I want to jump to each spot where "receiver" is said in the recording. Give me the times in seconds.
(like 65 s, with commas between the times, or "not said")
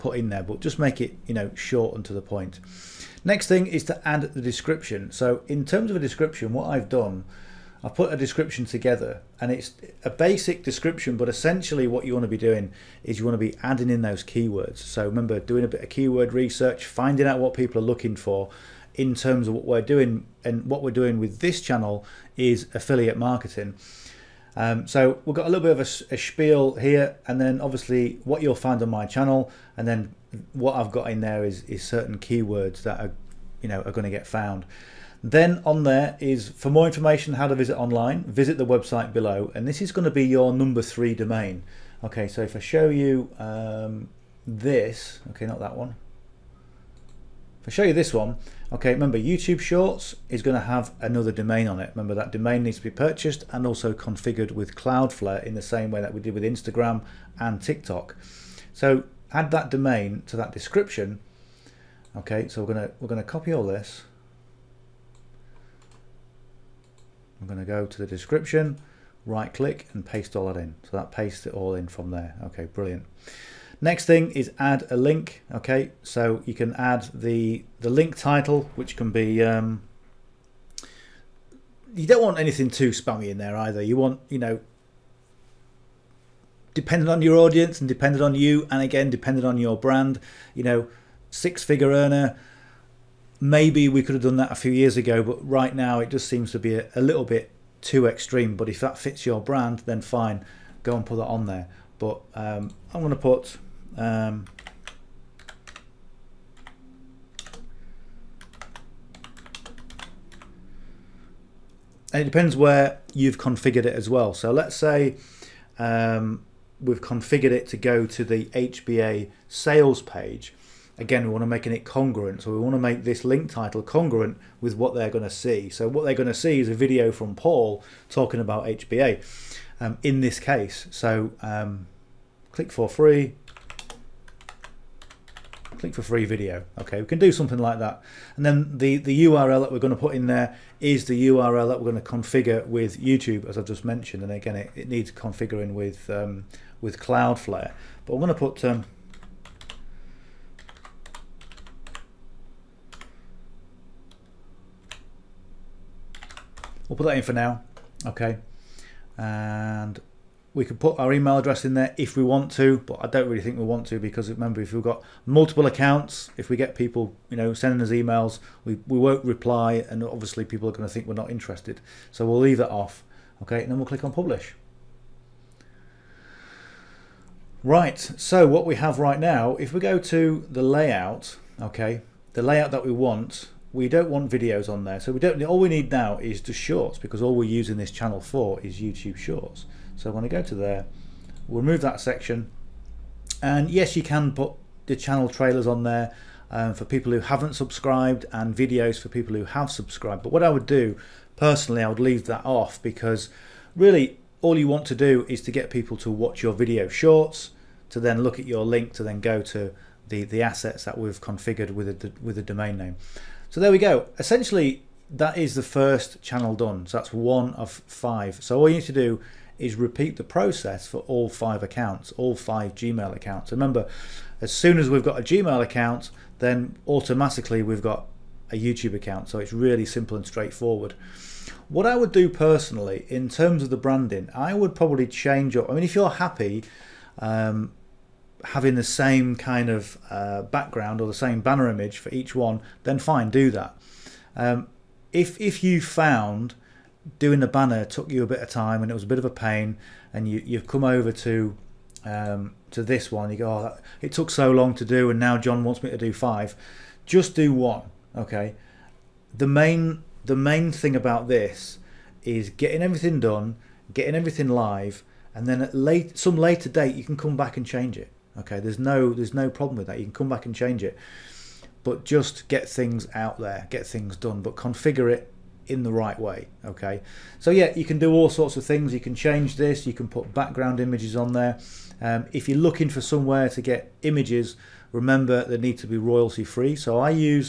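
not said.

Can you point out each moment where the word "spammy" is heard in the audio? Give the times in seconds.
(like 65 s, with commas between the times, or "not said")
82 s.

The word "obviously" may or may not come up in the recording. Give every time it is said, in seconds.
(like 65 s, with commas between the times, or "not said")
27 s, 170 s.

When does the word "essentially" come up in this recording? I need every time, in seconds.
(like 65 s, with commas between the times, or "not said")
11 s, 214 s.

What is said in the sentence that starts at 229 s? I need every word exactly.
So it's really simple and straightforward.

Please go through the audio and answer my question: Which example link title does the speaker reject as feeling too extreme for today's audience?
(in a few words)
Six figure earner.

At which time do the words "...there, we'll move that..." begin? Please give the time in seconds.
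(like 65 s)
190 s.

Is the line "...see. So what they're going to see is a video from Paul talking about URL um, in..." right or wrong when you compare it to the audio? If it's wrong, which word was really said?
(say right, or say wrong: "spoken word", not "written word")
wrong: "HBA", not "URL".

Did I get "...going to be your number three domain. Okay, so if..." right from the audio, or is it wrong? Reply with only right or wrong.
right.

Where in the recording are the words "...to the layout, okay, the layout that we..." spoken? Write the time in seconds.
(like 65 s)
179 s.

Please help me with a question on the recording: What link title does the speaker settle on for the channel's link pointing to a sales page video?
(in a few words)
Click for free video.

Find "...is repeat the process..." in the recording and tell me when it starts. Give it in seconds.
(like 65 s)
219 s.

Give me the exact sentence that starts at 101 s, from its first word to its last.
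But um, I'm going to put um, and it depends where you've configured it as well.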